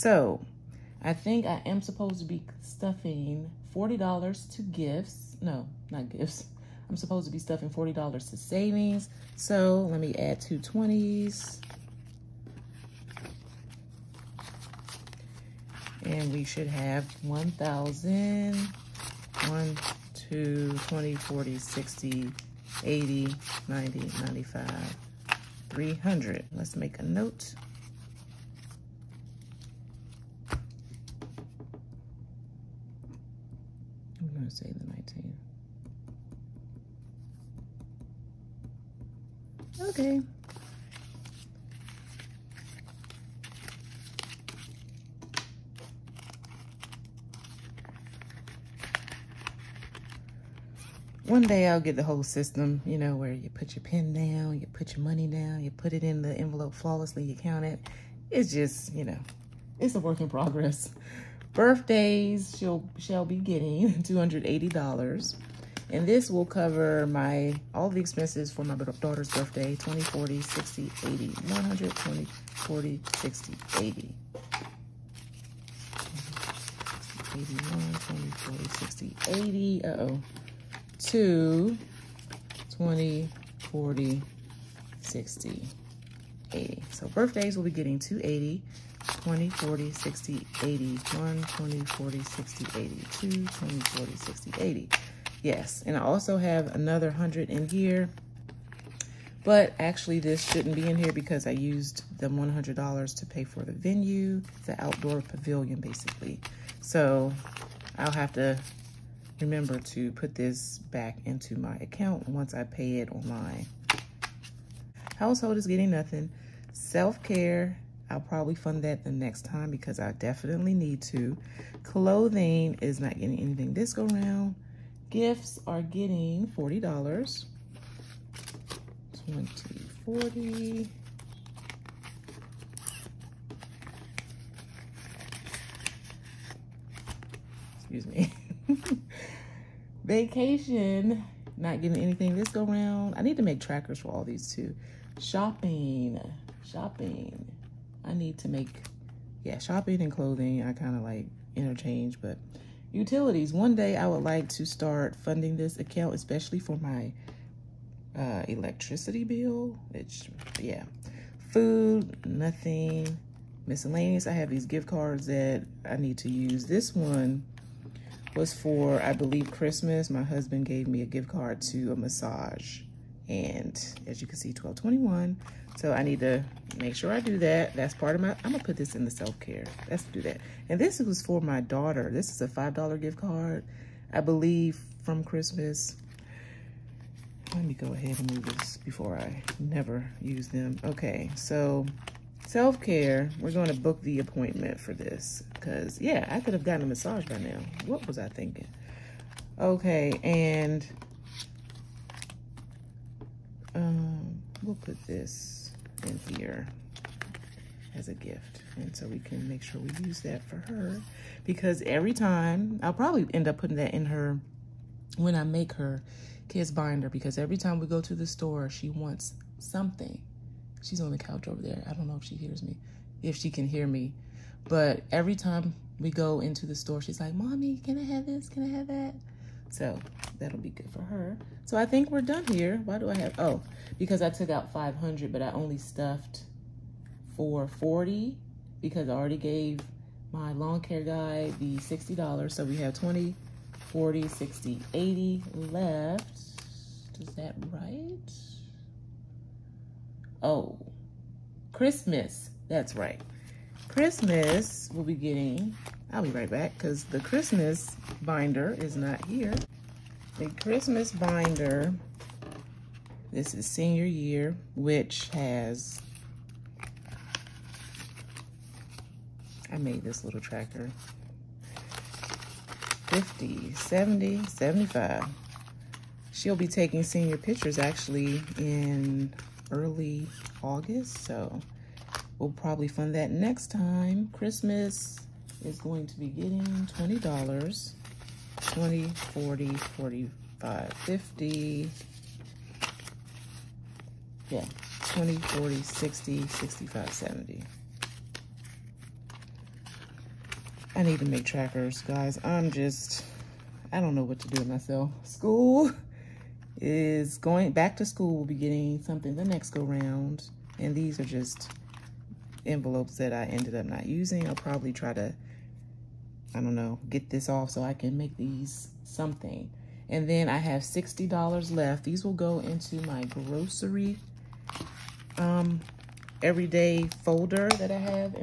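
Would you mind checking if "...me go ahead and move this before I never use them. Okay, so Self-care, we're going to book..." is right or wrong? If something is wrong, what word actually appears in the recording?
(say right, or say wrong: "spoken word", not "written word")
right.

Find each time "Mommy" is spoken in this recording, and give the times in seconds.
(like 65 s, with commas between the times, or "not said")
227 s.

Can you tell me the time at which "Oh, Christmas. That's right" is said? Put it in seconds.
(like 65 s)
250 s.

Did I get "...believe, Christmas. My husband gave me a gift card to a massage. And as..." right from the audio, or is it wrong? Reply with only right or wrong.
right.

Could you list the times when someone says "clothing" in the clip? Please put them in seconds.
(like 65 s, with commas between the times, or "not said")
121 s, 150 s.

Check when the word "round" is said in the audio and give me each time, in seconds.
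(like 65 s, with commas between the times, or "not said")
124 s, 142 s, 309 s.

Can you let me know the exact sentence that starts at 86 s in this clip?
So birthdays will be getting 280, 20, 40, 60, 80, 1, 20, 40, 60, 80, 2, 20, 40, 60, 80.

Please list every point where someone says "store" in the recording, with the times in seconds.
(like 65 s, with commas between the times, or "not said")
218 s, 226 s.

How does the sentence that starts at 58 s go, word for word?
It's just, you know, it's a work in progress.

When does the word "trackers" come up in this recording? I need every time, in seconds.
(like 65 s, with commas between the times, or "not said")
143 s, 270 s, 301 s.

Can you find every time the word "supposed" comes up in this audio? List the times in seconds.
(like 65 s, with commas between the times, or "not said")
1 s, 6 s.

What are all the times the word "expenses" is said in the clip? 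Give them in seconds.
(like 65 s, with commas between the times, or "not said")
68 s.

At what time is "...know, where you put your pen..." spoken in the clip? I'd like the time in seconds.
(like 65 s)
52 s.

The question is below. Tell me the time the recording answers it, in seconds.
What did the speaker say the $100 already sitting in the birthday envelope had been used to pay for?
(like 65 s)
104 s.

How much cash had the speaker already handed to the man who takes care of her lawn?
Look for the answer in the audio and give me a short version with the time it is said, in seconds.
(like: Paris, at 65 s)
$60, at 241 s.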